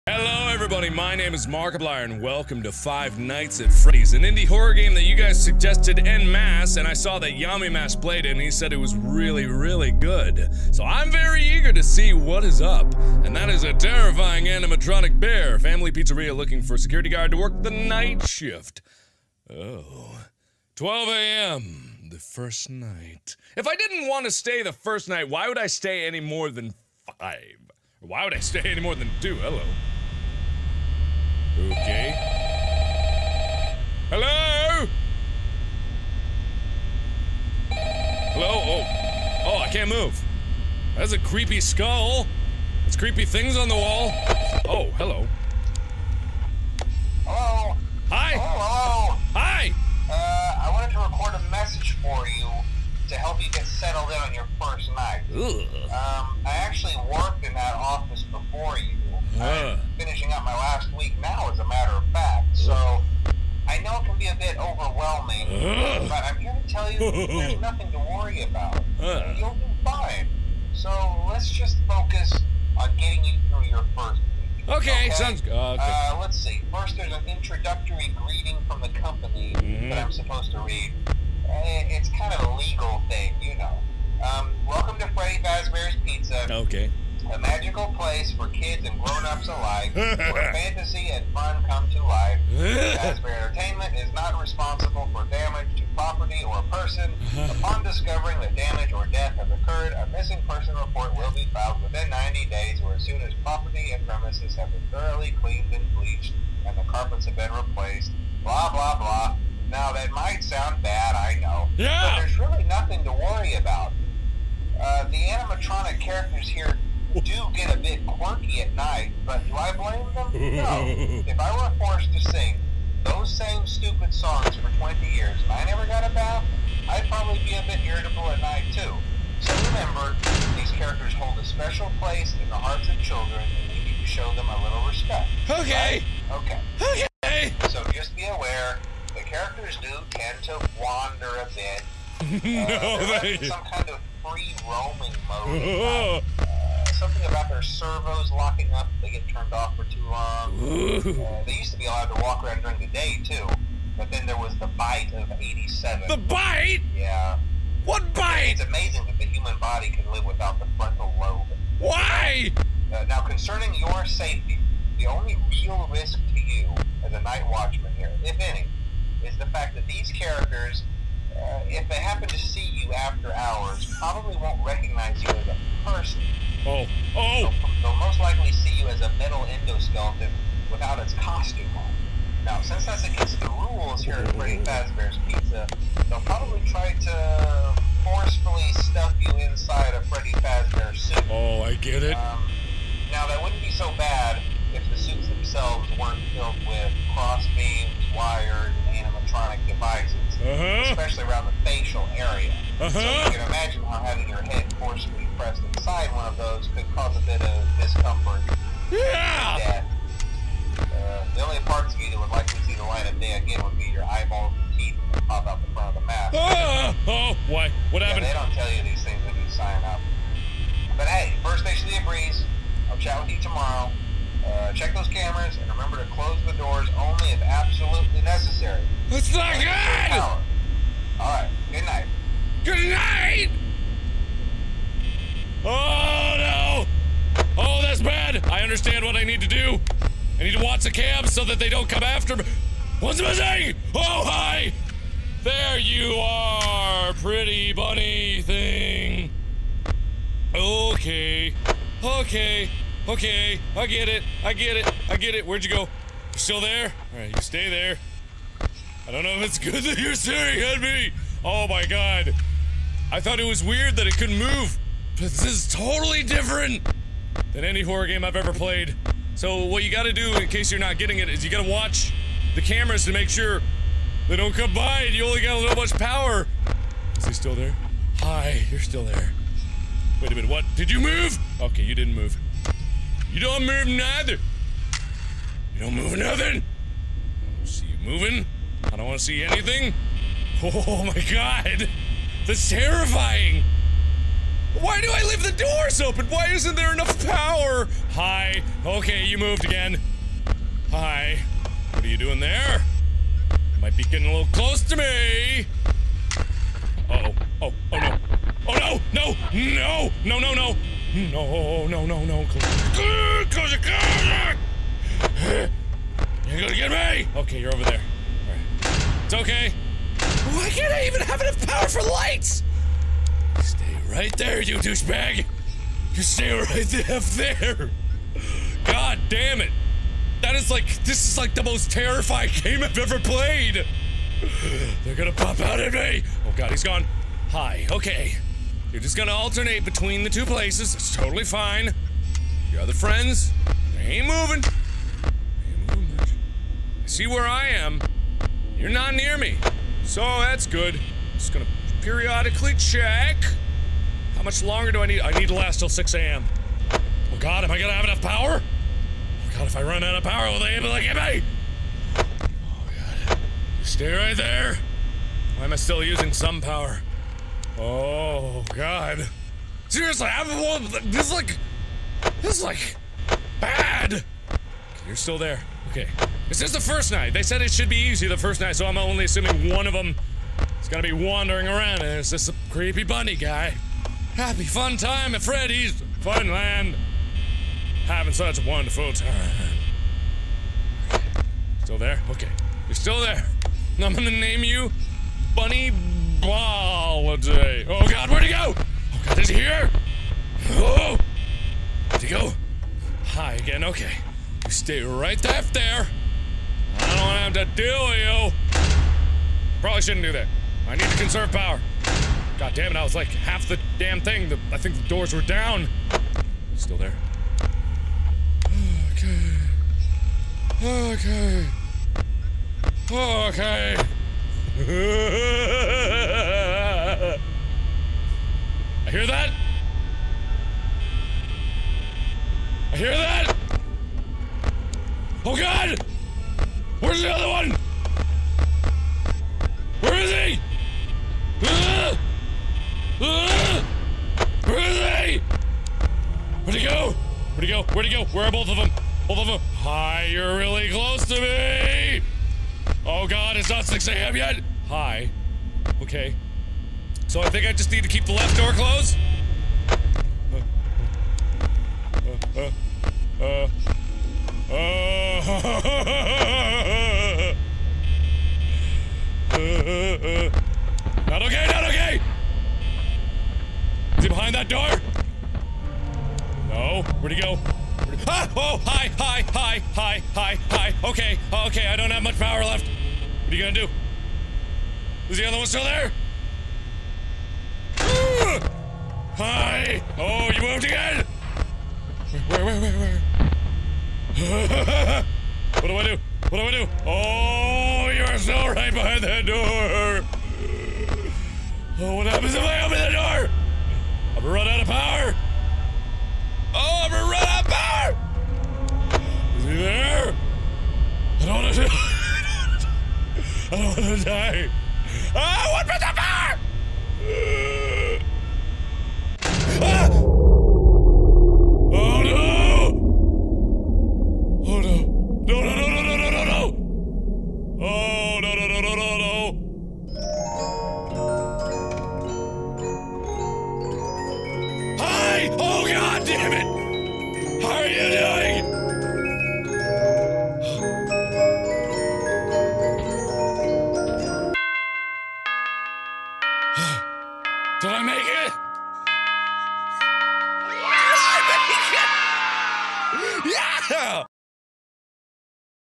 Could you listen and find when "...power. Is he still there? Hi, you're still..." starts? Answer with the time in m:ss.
4:35.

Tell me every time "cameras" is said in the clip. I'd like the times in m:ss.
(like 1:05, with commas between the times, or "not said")
3:45, 4:32.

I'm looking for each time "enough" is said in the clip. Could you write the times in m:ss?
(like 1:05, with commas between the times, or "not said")
4:56, 5:21, 5:58.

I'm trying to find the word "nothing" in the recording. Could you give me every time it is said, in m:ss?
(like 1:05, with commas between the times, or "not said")
1:07, 1:52, 4:46.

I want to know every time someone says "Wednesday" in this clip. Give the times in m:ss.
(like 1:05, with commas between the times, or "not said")
not said.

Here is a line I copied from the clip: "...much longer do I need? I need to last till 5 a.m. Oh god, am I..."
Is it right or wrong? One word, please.
wrong.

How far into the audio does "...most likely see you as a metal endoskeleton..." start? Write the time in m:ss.
2:57.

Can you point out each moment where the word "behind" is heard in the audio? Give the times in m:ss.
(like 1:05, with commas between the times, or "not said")
7:54, 8:18.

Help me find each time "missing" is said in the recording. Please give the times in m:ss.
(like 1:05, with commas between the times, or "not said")
1:40, 4:03.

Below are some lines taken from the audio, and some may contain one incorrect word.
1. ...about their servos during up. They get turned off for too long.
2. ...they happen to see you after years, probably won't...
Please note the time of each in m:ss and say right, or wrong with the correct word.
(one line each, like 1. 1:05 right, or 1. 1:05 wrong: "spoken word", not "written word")
1. 2:27 wrong: "locking", not "during"
2. 2:51 wrong: "hours", not "years".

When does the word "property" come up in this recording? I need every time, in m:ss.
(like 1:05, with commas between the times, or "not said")
1:35, 1:43.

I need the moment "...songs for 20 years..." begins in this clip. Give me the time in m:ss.
2:04.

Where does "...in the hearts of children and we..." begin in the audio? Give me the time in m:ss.
2:12.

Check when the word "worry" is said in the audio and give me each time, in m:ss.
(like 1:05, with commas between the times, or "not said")
1:07, 1:53.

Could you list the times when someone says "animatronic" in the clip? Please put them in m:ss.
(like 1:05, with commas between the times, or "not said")
0:14, 1:55, 3:19.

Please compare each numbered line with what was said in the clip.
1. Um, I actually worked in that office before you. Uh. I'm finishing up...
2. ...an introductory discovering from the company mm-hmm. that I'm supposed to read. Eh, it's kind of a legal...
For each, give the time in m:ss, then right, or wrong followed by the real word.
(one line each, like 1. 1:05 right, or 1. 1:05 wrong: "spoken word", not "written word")
1. 0:55 right
2. 1:17 wrong: "greeting", not "discovering".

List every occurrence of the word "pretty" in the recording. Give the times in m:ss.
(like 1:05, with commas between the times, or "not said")
4:07.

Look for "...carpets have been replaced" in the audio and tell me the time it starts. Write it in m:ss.
1:46.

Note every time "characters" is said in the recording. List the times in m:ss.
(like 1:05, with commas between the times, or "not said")
1:56, 2:10, 2:19, 2:50.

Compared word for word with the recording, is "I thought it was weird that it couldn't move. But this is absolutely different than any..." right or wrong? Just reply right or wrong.
wrong.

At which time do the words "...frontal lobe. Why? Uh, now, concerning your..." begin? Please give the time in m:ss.
2:40.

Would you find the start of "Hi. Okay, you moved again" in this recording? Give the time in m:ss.
4:58.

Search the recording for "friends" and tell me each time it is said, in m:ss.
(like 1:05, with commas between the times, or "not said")
5:42.